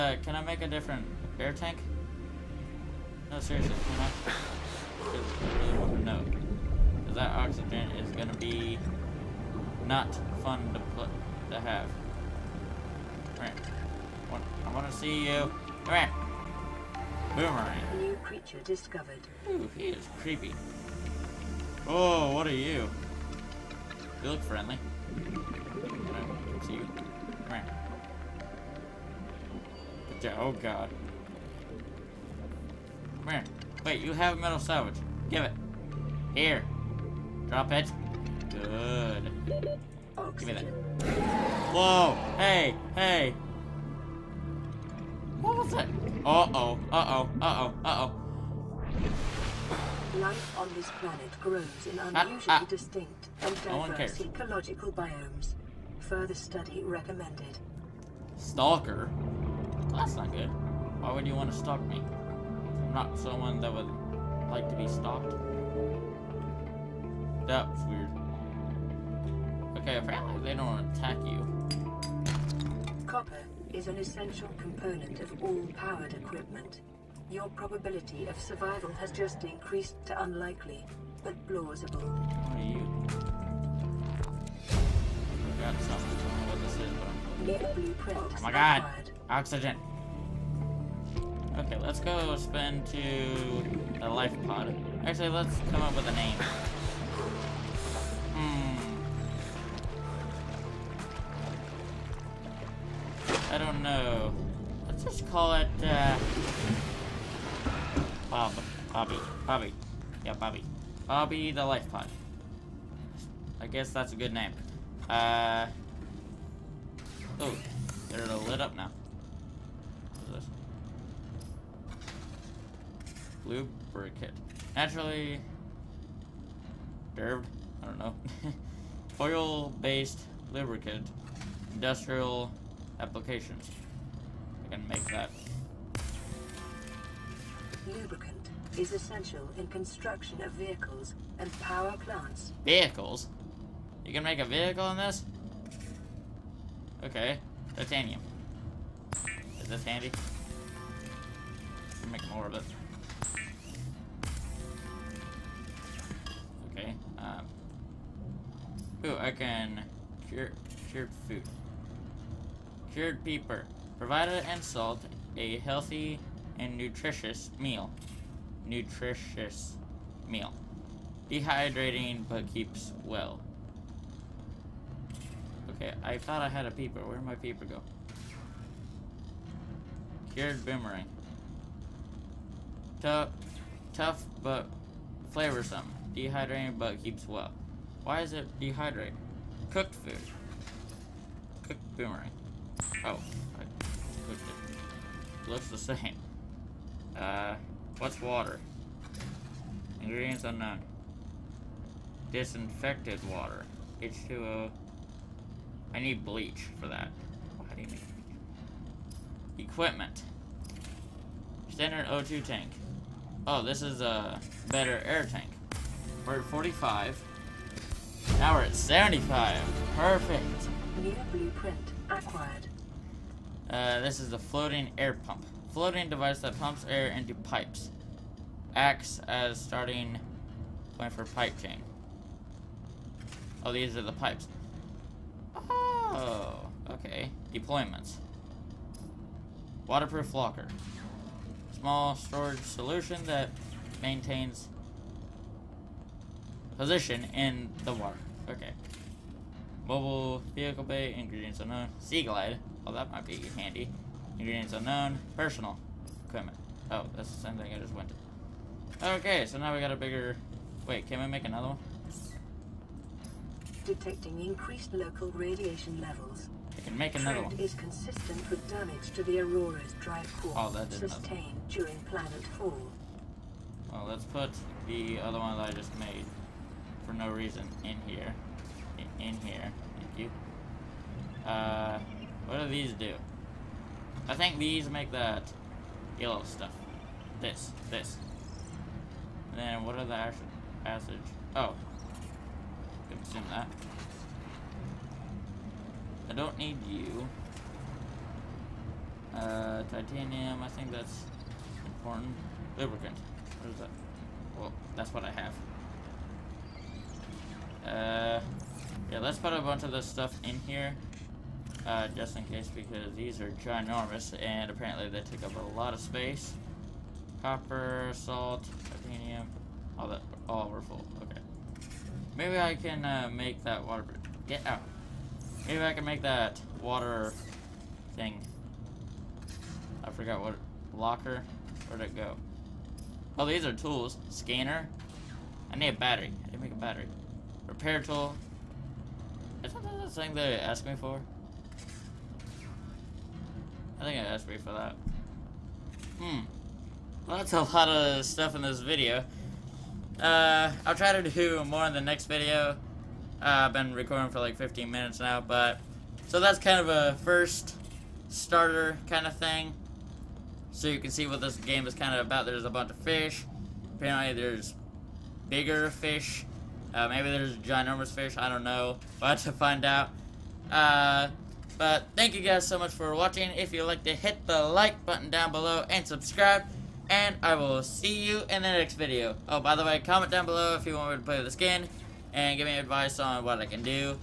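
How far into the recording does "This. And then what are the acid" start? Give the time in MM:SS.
04:47.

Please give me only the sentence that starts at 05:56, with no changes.
So that's kind of a first starter kind of thing.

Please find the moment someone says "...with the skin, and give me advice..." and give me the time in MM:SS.
06:21.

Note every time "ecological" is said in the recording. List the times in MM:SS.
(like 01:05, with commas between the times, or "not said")
00:54.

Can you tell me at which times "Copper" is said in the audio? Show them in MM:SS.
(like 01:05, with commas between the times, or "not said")
01:13, 05:17.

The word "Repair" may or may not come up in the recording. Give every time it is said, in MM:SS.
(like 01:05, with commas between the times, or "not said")
05:37.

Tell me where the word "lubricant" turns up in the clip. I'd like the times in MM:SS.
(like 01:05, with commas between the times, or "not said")
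02:03, 02:10, 02:17, 05:02.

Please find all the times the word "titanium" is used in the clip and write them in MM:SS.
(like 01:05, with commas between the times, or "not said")
02:27, 04:59, 05:18.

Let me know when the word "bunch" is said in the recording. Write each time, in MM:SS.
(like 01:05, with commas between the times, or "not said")
05:09, 06:02.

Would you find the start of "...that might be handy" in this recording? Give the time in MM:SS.
04:12.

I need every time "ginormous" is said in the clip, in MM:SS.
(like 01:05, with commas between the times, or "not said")
05:13, 06:07.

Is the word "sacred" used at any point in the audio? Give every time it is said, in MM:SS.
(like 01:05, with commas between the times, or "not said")
not said.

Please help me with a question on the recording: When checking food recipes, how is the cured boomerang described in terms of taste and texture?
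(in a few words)
Tough but flavorsome.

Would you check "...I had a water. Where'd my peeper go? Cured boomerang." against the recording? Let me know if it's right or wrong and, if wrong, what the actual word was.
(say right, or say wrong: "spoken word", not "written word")
wrong: "peeper", not "water".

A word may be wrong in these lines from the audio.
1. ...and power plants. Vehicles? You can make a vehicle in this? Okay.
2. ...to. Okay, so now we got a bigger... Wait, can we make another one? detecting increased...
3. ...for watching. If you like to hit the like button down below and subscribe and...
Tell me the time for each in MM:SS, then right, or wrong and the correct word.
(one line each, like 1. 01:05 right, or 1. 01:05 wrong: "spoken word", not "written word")
1. 02:21 right
2. 04:18 right
3. 06:12 right.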